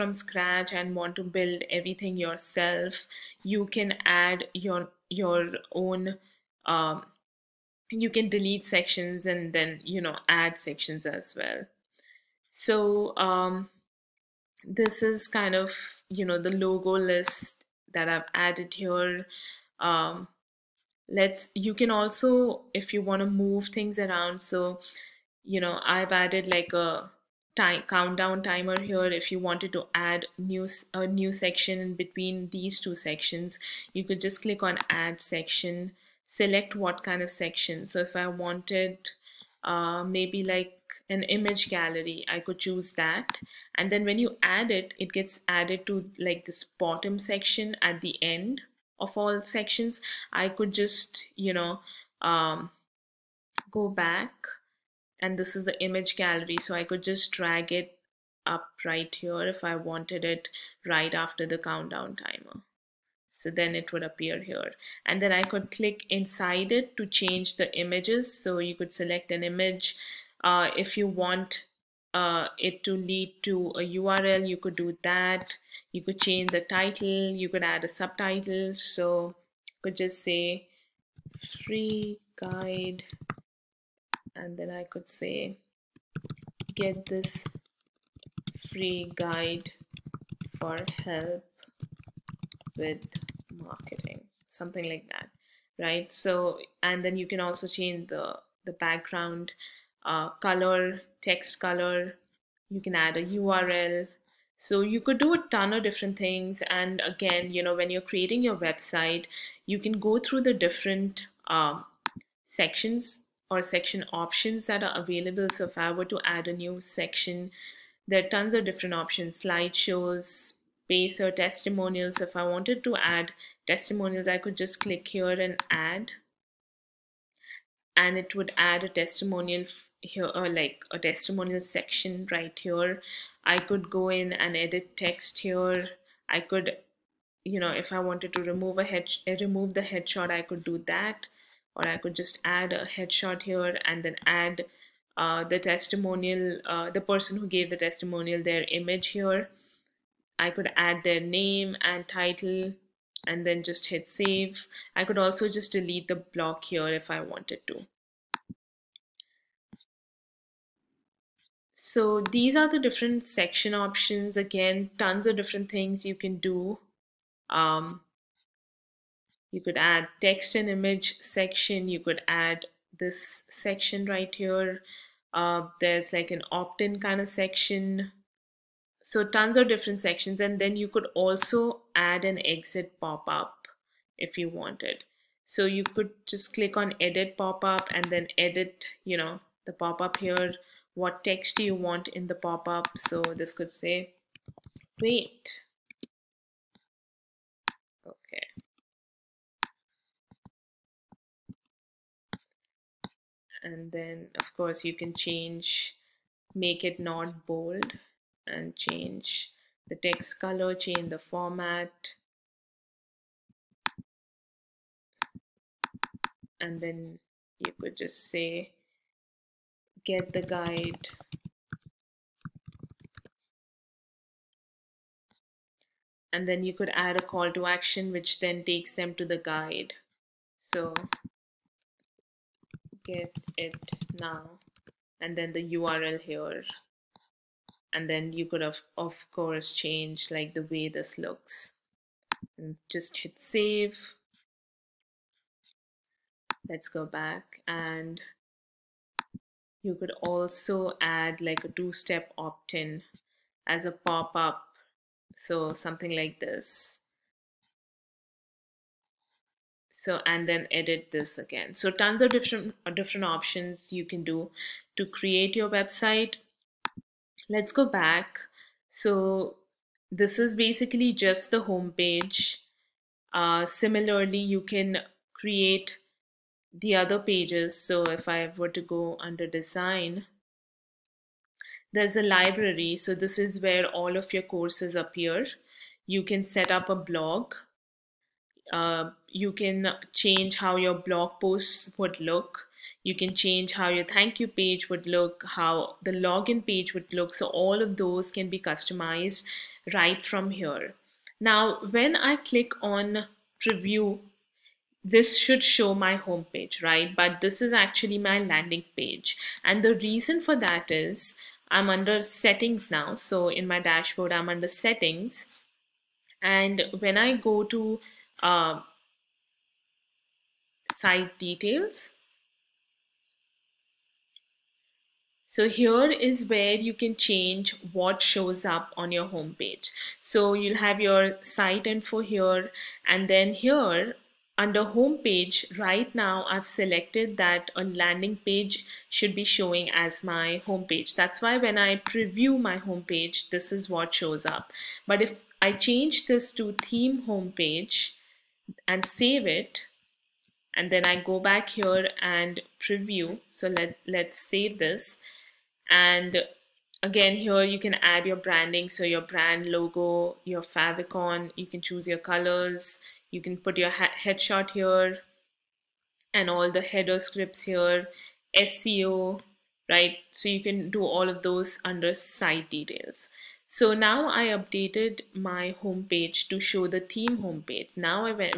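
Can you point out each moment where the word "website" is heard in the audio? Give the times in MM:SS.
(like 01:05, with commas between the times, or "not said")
01:48, 04:25.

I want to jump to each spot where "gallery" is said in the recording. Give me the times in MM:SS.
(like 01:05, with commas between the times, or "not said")
00:41, 00:56.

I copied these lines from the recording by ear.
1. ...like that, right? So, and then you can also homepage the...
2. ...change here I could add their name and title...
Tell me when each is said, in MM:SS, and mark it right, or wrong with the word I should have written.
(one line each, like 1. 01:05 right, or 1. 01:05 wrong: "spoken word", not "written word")
1. 01:34 wrong: "change", not "homepage"
2. 02:28 wrong: "image", not "change".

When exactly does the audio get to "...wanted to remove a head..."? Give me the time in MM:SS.
02:17.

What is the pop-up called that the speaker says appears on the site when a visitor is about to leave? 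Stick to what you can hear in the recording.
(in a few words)
exit pop-up.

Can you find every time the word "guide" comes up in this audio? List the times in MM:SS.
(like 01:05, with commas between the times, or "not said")
01:22, 01:29, 03:40, 03:49.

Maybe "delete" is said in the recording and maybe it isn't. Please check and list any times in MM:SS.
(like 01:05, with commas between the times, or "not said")
00:08, 02:35.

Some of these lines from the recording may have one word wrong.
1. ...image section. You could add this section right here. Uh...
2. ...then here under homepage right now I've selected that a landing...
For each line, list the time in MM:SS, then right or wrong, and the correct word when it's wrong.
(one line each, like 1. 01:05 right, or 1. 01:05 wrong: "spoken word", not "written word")
1. 02:50 right
2. 05:33 right.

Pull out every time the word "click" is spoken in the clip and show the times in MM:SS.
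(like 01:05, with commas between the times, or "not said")
00:34, 01:05, 02:04, 03:06, 05:02.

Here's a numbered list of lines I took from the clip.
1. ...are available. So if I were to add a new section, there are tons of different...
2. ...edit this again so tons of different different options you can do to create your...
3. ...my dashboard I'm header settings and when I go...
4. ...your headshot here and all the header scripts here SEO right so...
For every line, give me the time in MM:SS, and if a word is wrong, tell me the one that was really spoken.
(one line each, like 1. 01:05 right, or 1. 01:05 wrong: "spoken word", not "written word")
1. 01:54 right
2. 04:20 right
3. 05:13 wrong: "under", not "header"
4. 06:03 right.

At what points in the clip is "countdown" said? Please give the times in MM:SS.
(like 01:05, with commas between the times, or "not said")
00:27, 01:01.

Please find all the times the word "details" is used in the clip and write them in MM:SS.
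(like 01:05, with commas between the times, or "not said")
05:21, 06:12.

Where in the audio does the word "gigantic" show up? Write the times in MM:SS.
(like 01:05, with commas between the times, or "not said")
not said.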